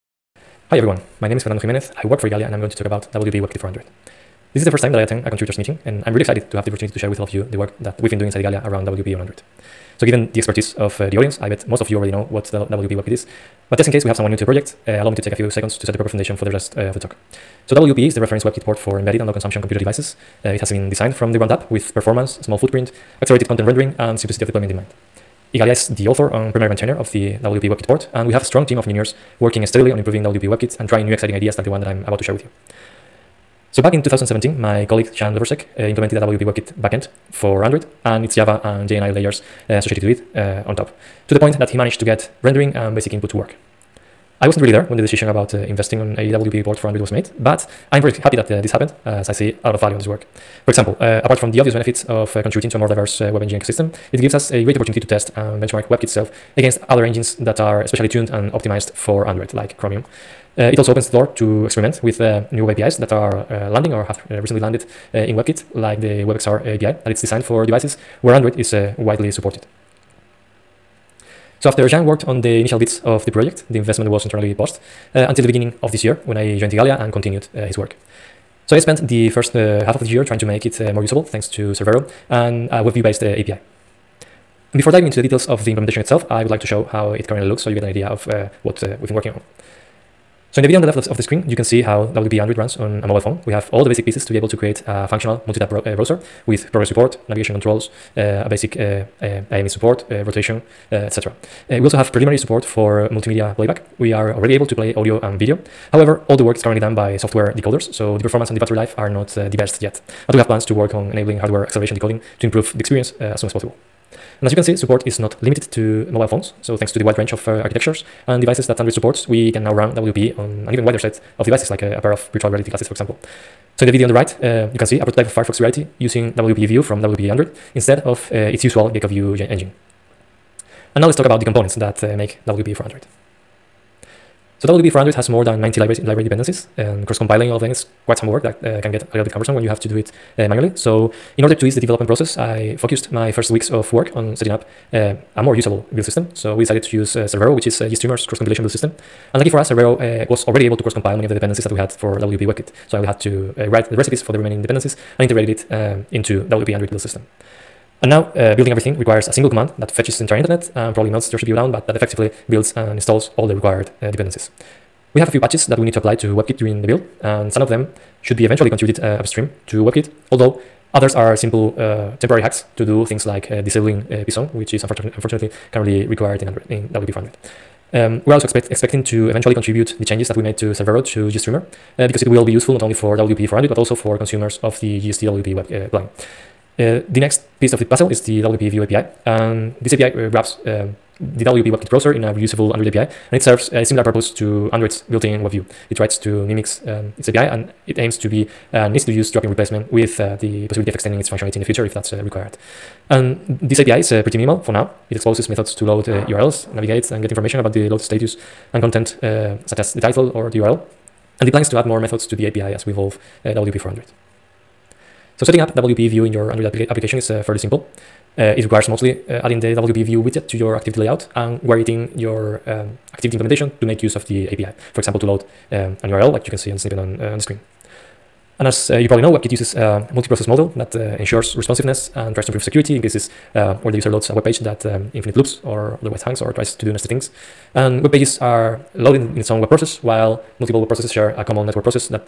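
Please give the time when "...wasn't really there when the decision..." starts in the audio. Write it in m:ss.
0:44.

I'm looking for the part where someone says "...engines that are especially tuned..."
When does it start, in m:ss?
0:57.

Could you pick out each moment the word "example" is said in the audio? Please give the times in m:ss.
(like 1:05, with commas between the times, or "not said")
0:50, 2:02, 3:45.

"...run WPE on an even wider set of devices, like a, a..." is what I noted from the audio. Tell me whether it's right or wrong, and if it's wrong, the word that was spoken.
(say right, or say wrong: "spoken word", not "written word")
right.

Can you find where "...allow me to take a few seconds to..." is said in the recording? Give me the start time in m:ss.
0:15.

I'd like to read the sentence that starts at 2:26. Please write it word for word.
So we decided to use Cerbero, uh, which is GStreamer's cross-compilation build system.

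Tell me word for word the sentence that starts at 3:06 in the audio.
Uh, the next piece of the puzzle is the WP View API.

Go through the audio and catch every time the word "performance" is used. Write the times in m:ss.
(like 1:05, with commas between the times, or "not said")
0:21, 1:48.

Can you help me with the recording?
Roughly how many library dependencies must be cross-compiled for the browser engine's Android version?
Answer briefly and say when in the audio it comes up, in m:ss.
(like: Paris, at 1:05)
more than 90, at 2:15.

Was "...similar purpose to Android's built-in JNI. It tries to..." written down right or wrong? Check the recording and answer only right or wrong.
wrong.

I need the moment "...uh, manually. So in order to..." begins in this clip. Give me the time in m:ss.
2:20.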